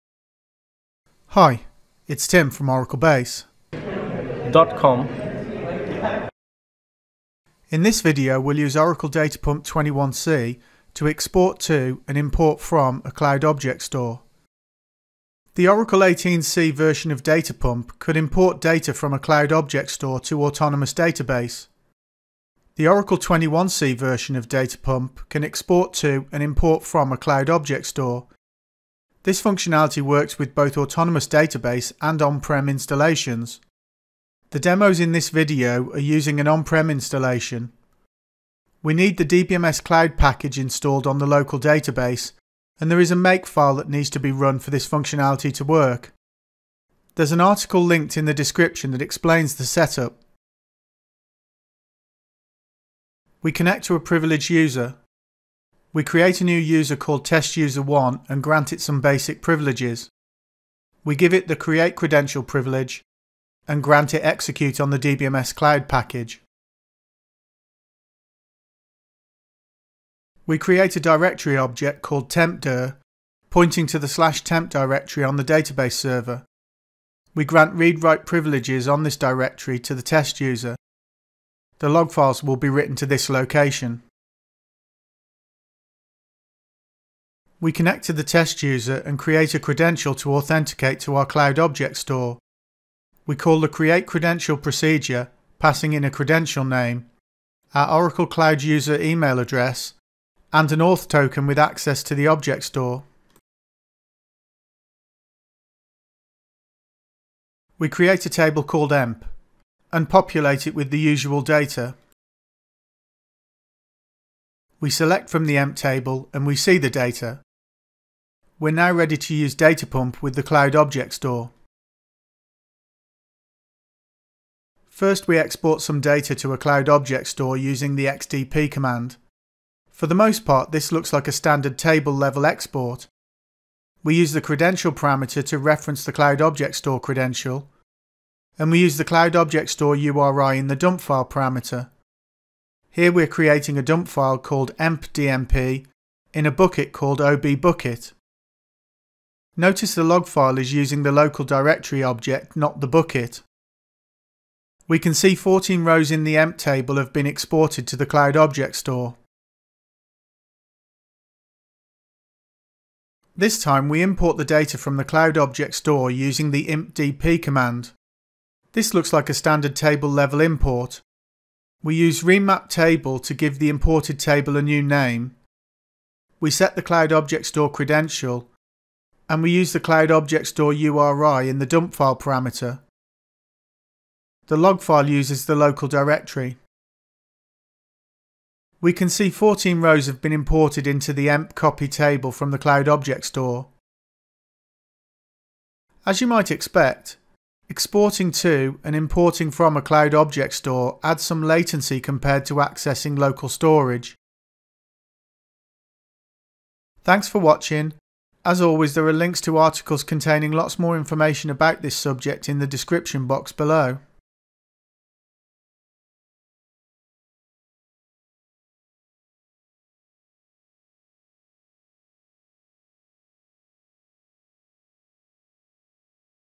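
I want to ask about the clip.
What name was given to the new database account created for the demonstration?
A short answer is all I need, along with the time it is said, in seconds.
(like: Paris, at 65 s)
testuser1, at 57 s.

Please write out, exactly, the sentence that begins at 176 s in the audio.
We set the Cloud Object Store credential and we use the Cloud Object Store URI in the dump file parameter.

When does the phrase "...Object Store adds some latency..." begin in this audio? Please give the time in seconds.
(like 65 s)
200 s.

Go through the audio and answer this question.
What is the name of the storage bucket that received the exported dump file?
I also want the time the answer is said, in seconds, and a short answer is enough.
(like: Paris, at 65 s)
obbucket, at 147 s.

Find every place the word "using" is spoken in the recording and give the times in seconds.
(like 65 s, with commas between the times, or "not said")
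35 s, 127 s, 150 s, 166 s.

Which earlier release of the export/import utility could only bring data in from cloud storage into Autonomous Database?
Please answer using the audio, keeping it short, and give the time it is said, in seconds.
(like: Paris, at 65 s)
Oracle 18c, at 15 s.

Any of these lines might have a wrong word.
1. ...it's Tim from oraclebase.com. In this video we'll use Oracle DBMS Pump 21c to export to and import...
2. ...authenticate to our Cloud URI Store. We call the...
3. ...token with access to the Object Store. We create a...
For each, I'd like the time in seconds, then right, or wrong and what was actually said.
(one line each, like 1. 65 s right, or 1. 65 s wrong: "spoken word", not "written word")
1. 2 s wrong: "Data", not "DBMS"
2. 90 s wrong: "Object", not "URI"
3. 101 s right.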